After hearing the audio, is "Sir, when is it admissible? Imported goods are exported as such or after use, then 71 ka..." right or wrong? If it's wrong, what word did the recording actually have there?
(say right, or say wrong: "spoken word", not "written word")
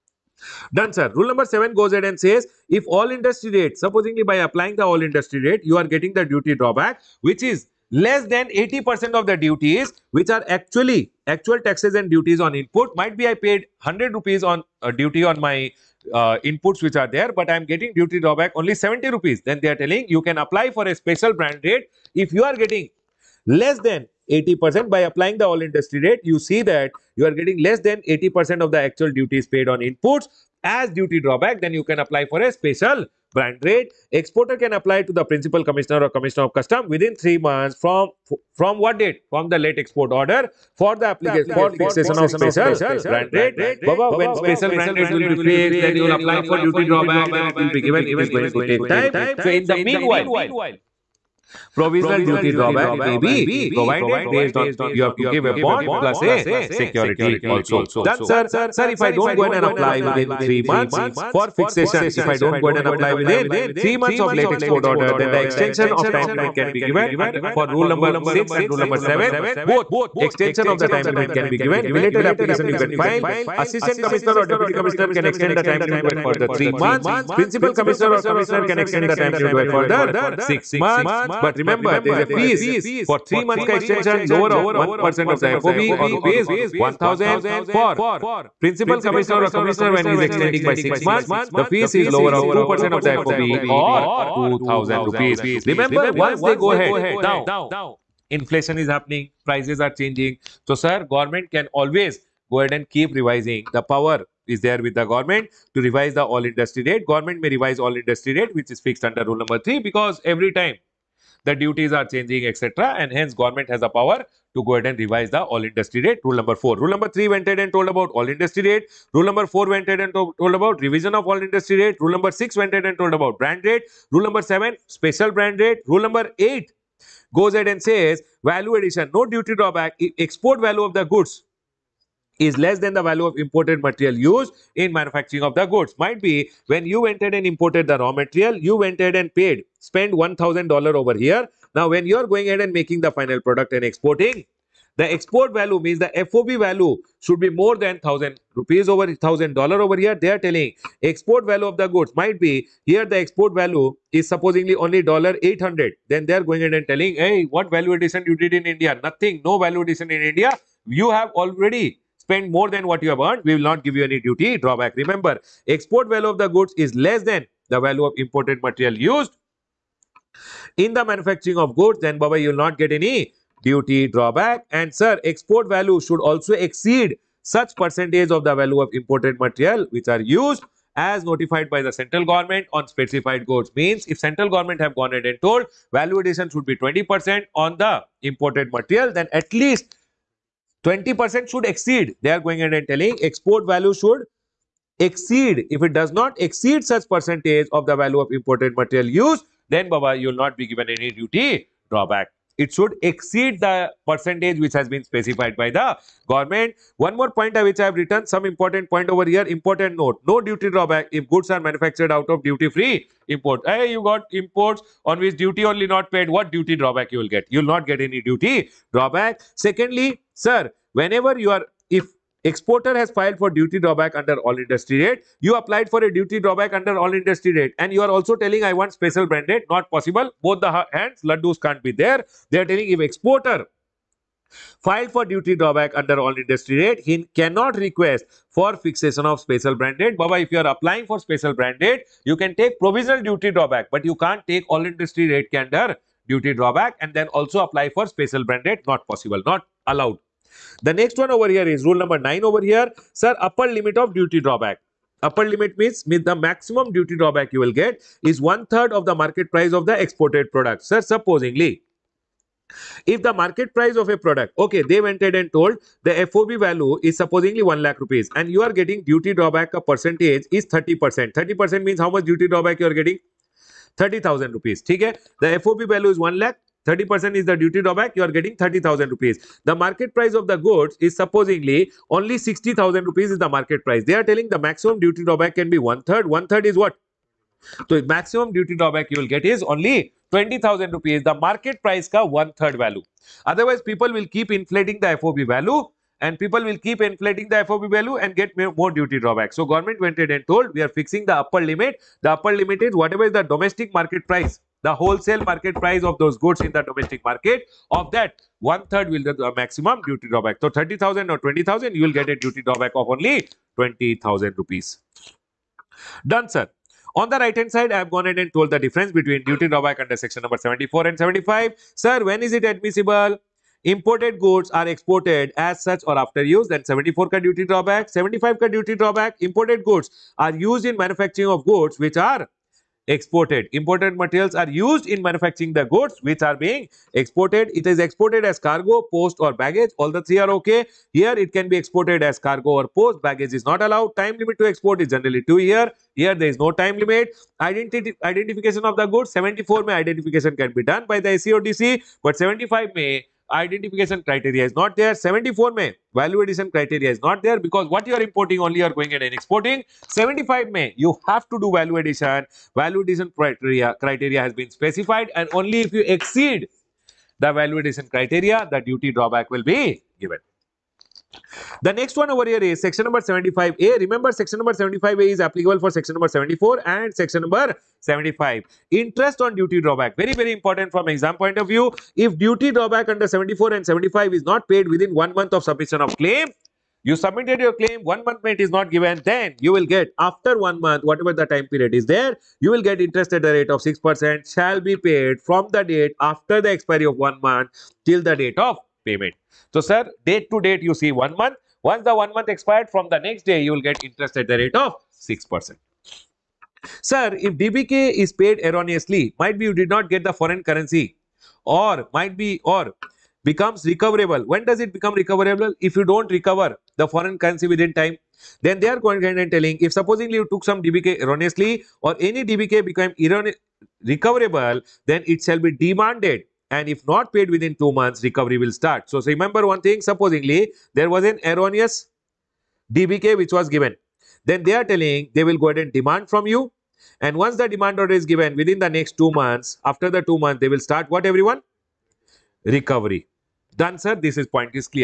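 wrong: "74", not "71".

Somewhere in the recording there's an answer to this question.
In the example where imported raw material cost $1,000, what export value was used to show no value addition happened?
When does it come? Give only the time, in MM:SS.
02:35.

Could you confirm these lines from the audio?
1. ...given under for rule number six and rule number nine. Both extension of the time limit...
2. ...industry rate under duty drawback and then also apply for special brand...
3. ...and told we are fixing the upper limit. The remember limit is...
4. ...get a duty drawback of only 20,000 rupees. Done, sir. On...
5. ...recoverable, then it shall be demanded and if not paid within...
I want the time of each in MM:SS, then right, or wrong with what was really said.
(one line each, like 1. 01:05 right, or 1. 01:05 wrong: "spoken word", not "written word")
1. 01:06 wrong: "seven", not "nine"
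2. 04:04 right
3. 05:00 wrong: "upper", not "remember"
4. 05:12 right
5. 07:04 right.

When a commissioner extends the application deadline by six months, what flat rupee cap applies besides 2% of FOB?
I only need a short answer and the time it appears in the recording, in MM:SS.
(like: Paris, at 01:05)
2000 rupees, at 01:34.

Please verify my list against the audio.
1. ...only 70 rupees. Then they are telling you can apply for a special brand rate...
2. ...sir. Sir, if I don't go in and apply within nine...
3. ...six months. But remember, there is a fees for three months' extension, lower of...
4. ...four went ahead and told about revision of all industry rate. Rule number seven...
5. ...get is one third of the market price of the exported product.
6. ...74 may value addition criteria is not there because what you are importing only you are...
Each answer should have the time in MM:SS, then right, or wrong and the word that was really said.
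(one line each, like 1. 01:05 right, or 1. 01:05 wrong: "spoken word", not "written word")
1. 00:18 right
2. 00:58 wrong: "three", not "nine"
3. 01:20 right
4. 01:59 wrong: "six", not "seven"
5. 04:17 right
6. 05:55 right.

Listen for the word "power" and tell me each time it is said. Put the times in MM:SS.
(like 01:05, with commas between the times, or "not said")
01:43, 01:53.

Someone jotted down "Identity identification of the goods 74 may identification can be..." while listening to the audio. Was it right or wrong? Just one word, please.
right.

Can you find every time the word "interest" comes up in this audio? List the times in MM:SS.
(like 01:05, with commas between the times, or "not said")
06:18, 06:32, 06:44.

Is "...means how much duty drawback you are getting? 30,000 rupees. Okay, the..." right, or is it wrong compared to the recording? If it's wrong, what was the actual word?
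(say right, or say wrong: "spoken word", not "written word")
right.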